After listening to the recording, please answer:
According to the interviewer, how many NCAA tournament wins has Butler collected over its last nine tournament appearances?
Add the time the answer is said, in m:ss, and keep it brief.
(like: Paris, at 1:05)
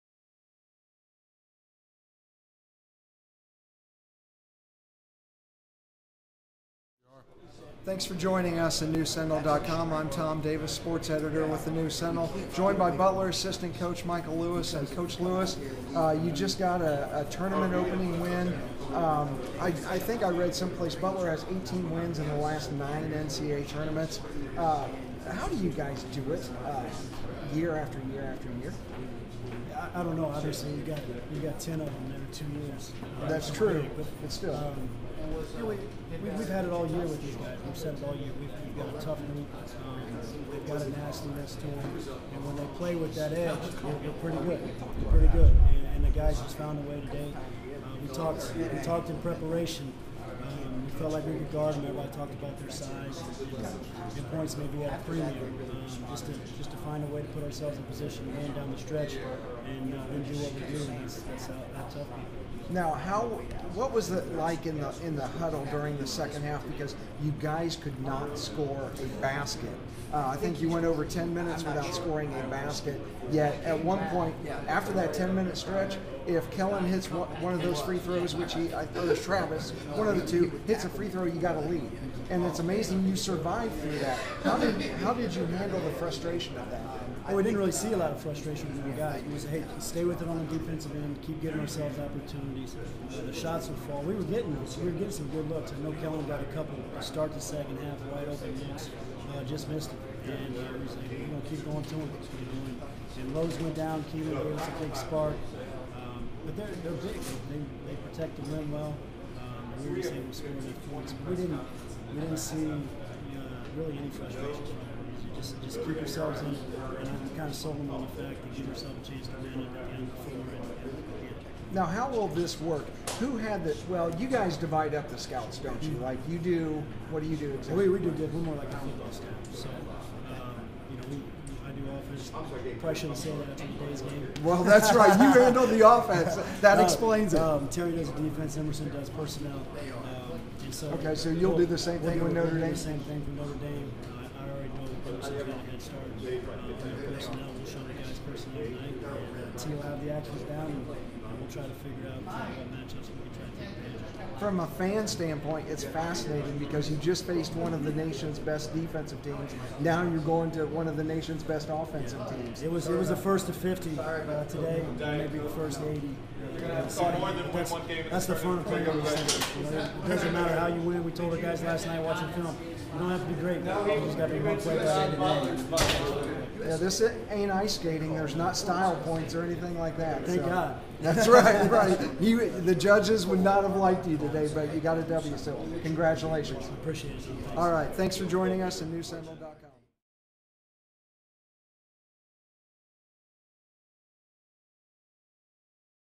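18, at 0:21.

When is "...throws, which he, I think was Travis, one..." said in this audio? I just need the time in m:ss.
1:17.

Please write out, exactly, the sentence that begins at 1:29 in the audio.
We just, hey, stay with it on the defensive end, keep getting ourselves opportunities.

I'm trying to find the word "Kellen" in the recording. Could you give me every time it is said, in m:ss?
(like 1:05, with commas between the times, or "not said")
1:16, 1:36.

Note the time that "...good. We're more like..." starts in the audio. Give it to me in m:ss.
2:08.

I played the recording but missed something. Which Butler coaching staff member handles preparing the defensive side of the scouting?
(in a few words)
Terry.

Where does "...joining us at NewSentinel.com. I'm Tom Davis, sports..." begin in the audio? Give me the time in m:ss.
0:08.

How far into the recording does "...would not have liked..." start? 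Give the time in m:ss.
3:03.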